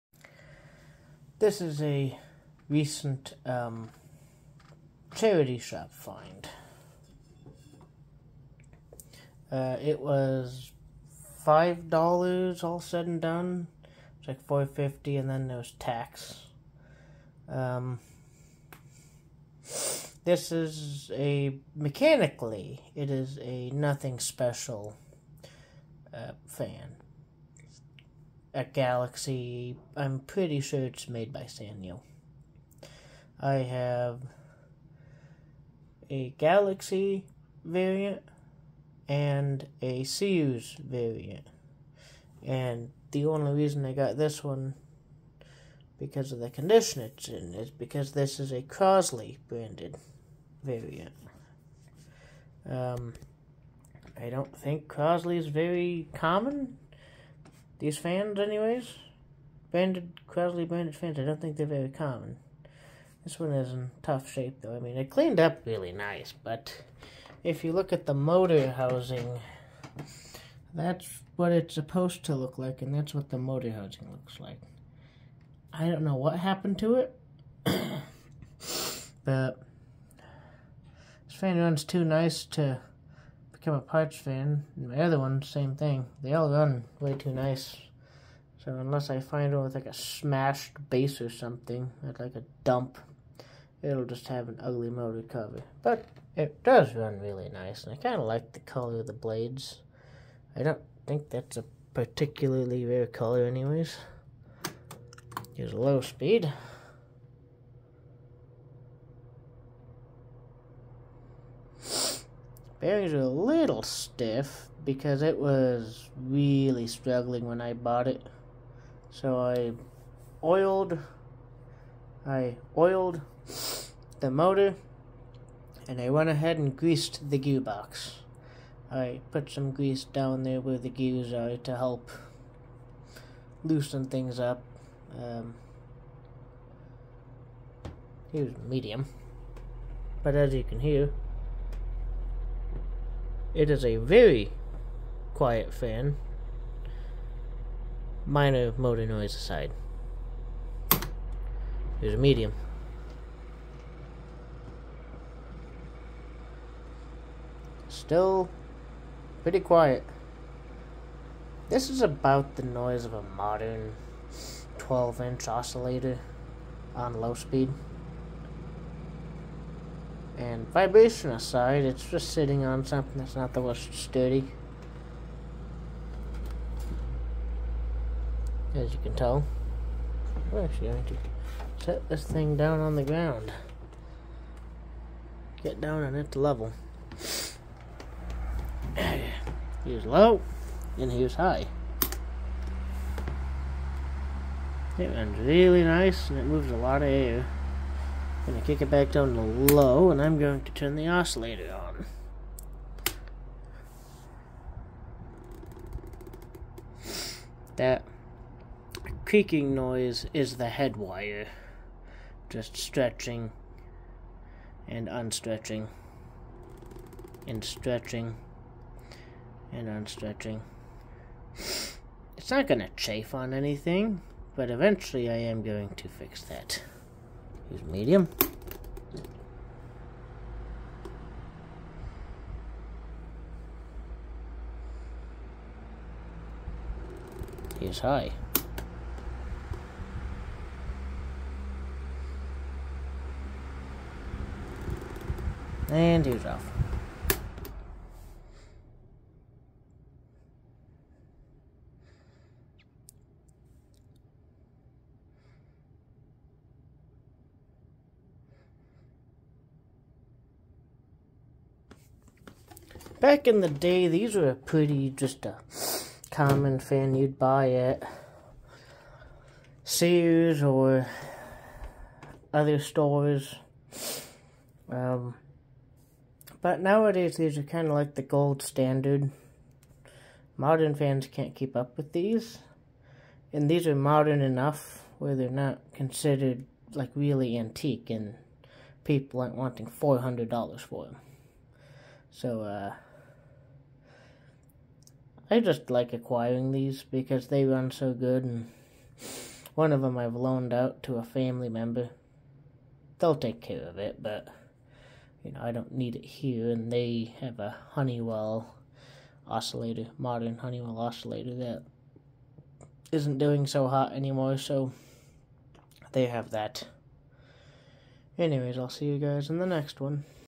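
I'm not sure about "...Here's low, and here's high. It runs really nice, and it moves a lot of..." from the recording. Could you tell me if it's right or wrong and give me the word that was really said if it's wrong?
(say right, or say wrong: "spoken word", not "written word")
right.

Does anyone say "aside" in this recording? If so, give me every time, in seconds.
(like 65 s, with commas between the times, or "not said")
149 s, 171 s.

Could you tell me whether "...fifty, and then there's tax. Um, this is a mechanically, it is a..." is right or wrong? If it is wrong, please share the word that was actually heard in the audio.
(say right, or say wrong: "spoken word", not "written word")
right.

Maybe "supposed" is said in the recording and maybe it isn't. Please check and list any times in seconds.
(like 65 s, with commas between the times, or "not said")
71 s.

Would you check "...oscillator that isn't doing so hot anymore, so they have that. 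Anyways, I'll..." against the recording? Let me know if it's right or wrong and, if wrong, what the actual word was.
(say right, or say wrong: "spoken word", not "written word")
right.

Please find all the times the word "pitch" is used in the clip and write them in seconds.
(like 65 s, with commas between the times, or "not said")
not said.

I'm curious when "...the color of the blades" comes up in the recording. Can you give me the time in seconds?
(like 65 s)
98 s.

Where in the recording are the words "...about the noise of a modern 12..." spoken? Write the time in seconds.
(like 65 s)
162 s.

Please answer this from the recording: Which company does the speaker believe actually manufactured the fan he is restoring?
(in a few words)
Sanyo.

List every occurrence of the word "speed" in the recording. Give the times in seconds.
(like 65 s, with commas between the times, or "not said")
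106 s, 167 s.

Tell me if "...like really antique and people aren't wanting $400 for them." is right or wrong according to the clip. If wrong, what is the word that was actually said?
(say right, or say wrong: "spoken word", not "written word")
right.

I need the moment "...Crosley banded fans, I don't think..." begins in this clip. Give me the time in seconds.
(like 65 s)
60 s.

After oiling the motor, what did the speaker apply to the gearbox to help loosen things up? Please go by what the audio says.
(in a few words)
Grease.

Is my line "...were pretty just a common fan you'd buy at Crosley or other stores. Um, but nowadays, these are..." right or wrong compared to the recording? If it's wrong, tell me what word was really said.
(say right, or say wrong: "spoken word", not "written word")
wrong: "Sears", not "Crosley".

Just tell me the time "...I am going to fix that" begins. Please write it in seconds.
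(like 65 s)
225 s.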